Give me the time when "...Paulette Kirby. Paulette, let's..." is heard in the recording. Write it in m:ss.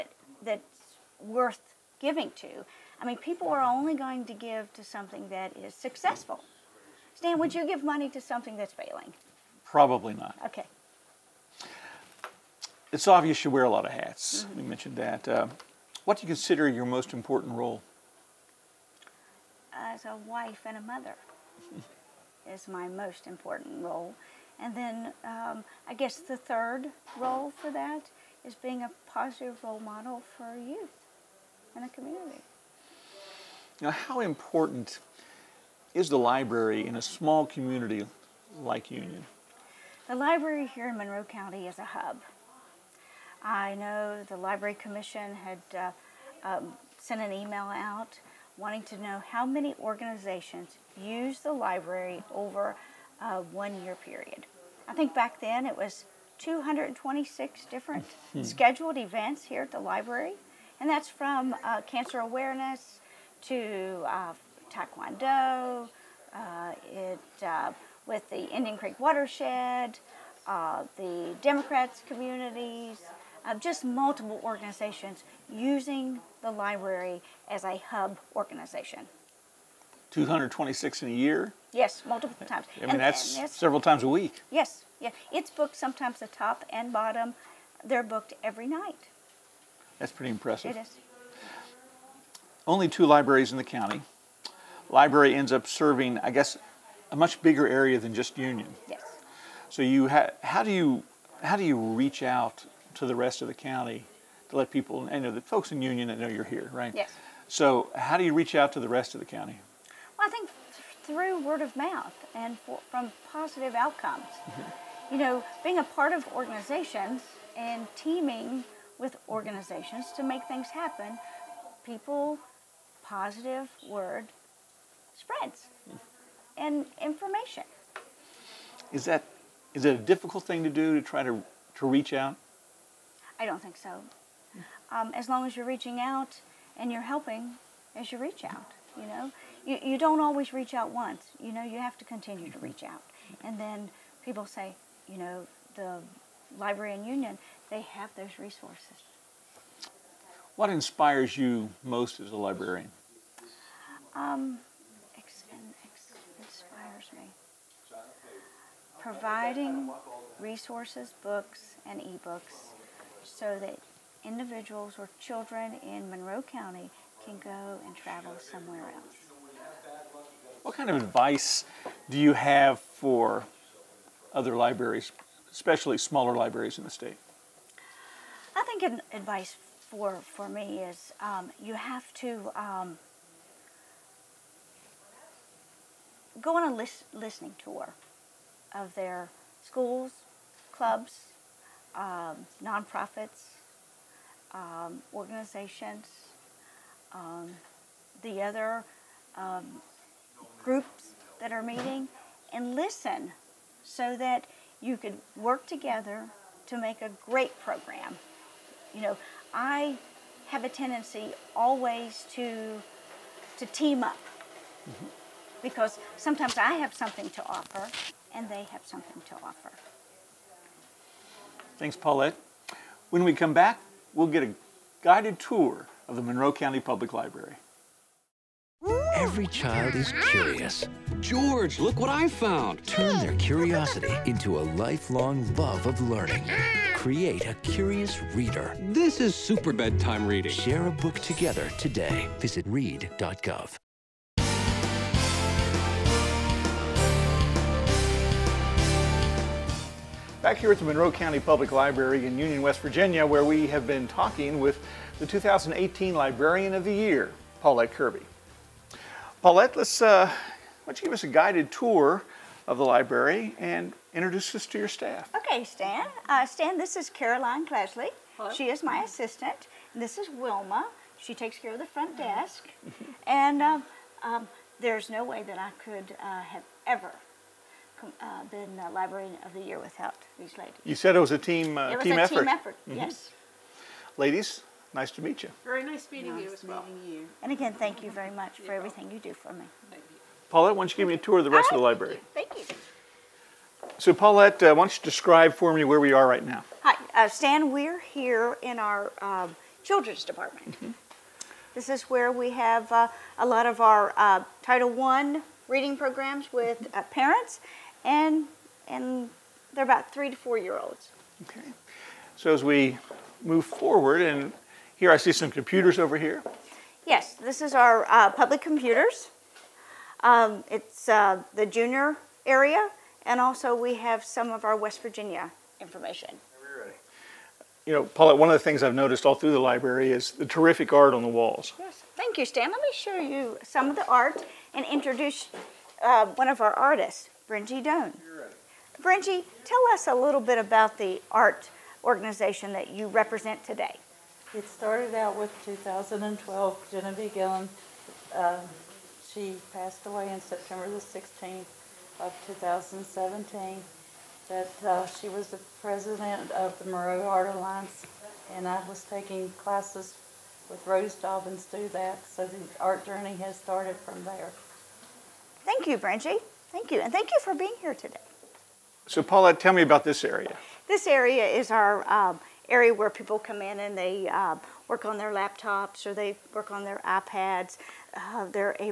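4:17.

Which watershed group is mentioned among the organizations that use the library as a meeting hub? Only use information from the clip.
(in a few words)
Indian Creek watershed.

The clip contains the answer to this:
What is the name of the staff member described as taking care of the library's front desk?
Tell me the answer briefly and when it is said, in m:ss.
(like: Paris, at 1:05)
Wilma, at 4:30.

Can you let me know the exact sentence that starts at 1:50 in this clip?
Well, I think through word of mouth and for, from positive outcomes.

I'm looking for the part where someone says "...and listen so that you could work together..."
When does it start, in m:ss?
3:22.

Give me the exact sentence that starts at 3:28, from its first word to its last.
You know, I have a tendency always to to team up mm-hmm.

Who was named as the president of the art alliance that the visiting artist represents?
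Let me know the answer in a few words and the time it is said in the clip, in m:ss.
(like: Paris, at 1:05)
Genevieve Gillen, at 5:46.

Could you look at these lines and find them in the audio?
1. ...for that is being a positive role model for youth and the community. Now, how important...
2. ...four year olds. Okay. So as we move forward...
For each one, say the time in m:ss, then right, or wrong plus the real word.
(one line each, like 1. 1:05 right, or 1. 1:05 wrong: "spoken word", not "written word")
1. 0:27 right
2. 5:10 right.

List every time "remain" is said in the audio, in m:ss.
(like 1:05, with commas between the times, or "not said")
not said.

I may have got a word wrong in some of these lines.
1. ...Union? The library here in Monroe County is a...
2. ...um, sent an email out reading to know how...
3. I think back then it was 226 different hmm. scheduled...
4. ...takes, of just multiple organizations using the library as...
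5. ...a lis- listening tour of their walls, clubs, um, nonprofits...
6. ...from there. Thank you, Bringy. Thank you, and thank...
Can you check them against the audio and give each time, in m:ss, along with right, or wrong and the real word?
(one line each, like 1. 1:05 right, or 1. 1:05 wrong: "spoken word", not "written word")
1. 0:38 right
2. 0:46 wrong: "wanting", not "reading"
3. 0:54 right
4. 1:12 wrong: "communities", not "takes"
5. 3:06 wrong: "schools", not "walls"
6. 6:03 right.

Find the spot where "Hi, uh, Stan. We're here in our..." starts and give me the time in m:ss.
4:56.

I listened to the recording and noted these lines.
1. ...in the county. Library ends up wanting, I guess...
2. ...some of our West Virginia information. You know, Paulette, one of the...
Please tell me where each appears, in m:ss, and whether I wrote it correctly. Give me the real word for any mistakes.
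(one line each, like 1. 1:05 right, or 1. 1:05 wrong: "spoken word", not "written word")
1. 1:33 wrong: "serving", not "wanting"
2. 5:24 right.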